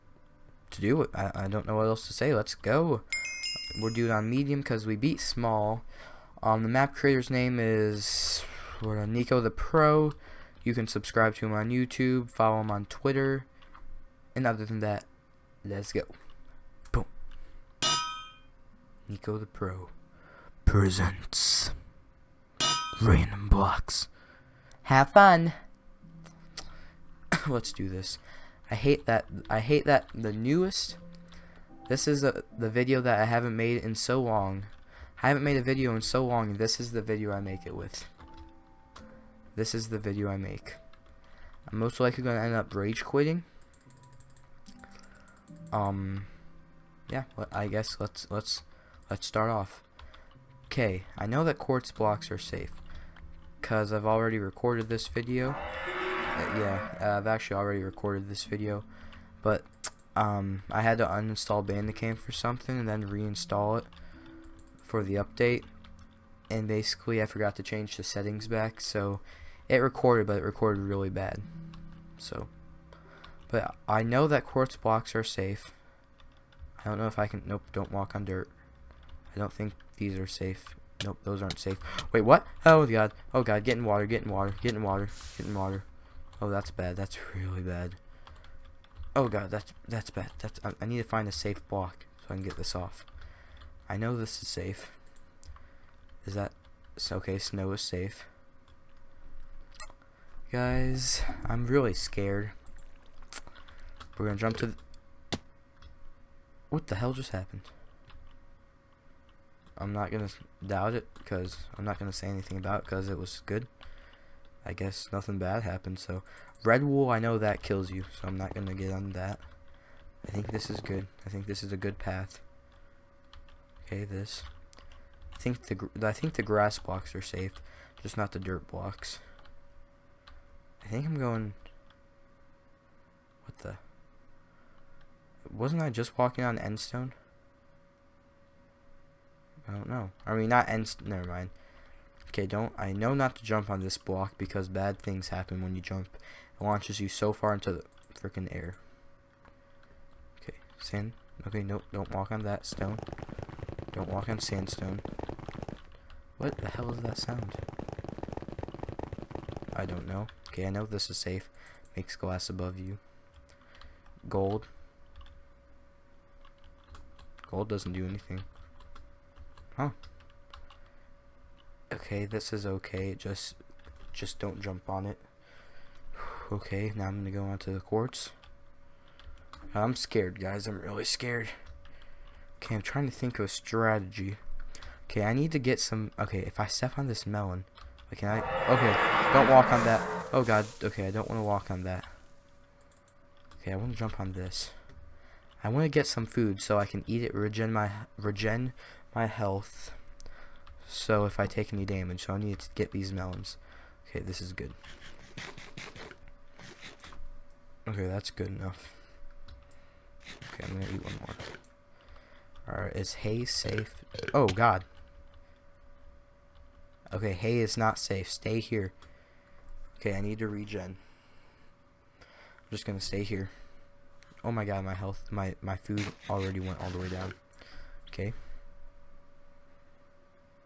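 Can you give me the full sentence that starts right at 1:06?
And basically, I forgot to change the settings back, so it recorded, but it recorded really bad.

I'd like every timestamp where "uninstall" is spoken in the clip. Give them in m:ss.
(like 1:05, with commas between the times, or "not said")
1:01.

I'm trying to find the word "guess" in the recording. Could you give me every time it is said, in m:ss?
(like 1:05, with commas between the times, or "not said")
0:47, 1:54.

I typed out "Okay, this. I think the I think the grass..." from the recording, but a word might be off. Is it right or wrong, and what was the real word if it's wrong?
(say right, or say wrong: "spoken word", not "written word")
right.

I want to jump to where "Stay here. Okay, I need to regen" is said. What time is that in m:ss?
3:38.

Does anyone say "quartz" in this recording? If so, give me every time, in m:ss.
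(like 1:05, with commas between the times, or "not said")
0:51, 1:14, 2:57.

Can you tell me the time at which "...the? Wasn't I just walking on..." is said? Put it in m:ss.
2:13.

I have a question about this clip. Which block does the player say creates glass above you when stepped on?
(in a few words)
I know this is safe. Makes glass above you.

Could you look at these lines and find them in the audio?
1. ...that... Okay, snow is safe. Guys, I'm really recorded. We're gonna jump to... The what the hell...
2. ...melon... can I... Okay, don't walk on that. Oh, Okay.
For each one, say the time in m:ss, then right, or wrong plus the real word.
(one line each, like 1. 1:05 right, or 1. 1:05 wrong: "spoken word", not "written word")
1. 1:36 wrong: "scared", not "recorded"
2. 3:07 wrong: "God", not "Okay".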